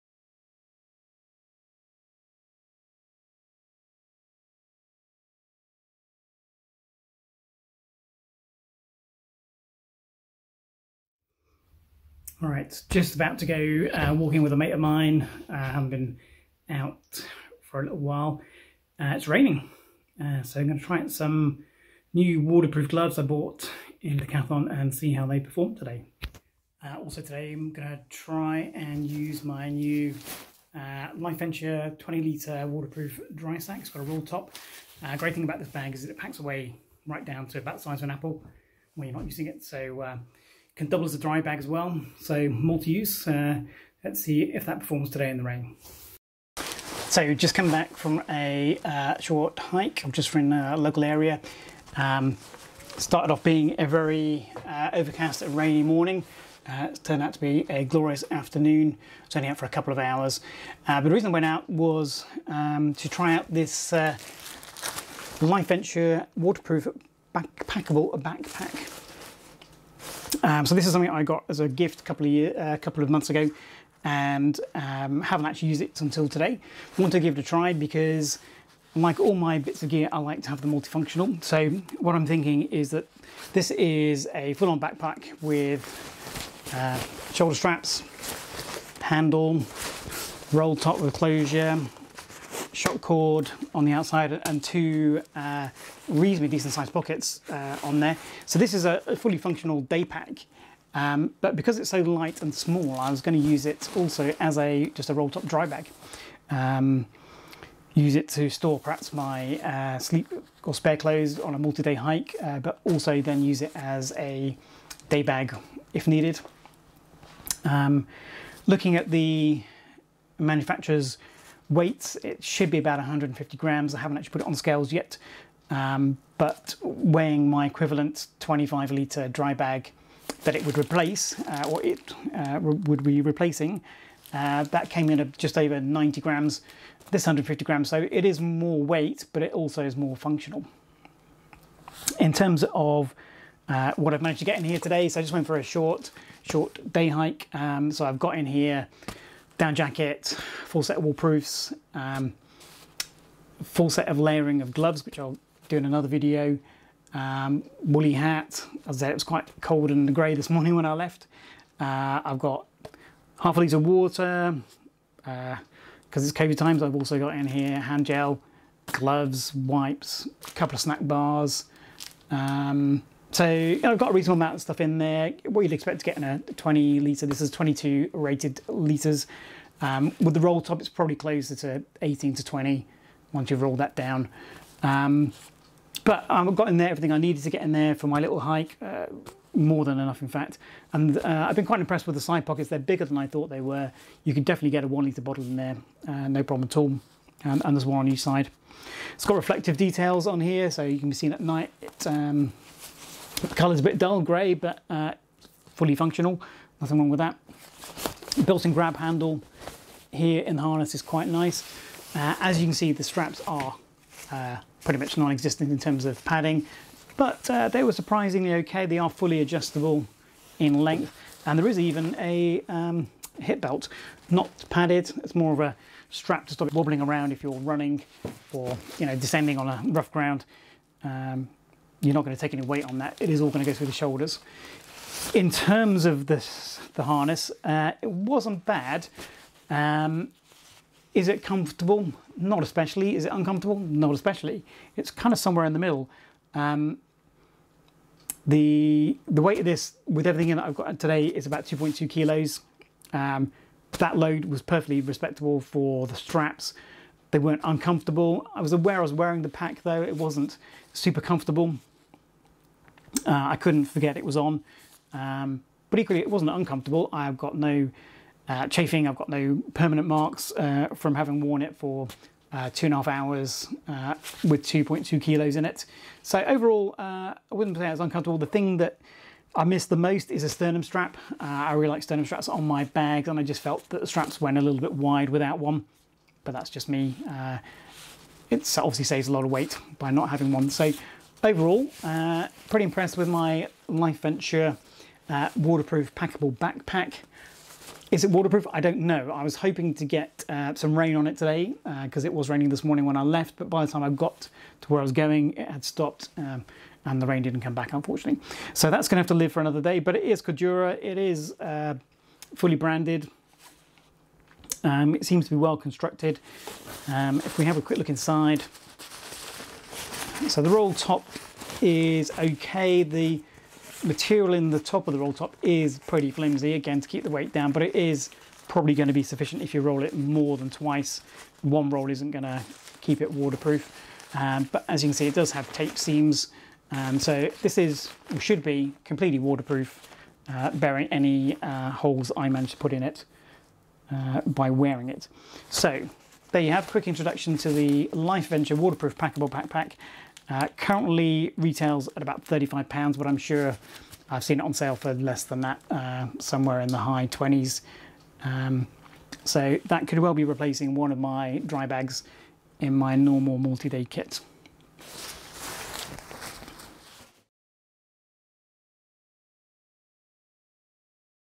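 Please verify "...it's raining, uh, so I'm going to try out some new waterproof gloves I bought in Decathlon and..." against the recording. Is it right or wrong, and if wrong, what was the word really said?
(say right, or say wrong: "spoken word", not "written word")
right.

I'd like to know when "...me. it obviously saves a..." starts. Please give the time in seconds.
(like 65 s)
286 s.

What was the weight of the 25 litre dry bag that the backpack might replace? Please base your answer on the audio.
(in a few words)
just over 90 grams.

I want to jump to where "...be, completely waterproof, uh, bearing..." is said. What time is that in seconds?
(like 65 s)
338 s.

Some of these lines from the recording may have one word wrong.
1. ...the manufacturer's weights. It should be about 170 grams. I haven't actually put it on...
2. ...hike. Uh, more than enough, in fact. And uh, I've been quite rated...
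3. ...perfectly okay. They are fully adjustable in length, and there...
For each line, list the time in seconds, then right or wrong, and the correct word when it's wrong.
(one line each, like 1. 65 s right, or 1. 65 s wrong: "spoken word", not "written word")
1. 119 s wrong: "150", not "170"
2. 188 s wrong: "impressed", not "rated"
3. 217 s wrong: "surprisingly", not "perfectly".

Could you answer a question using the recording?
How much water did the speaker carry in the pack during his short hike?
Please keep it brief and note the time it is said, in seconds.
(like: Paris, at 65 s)
half a litre, at 163 s.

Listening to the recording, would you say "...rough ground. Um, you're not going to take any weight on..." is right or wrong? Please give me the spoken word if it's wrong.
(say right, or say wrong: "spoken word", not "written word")
right.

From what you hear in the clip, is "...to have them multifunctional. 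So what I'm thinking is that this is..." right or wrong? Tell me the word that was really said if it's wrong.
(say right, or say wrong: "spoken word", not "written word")
right.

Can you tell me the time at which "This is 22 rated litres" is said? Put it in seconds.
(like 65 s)
177 s.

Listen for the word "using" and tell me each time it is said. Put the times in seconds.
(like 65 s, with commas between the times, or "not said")
39 s.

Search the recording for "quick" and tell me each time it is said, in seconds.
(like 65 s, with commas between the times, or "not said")
317 s, 346 s.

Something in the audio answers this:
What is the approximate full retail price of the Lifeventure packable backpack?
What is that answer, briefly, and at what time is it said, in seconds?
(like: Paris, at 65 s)
£35, at 352 s.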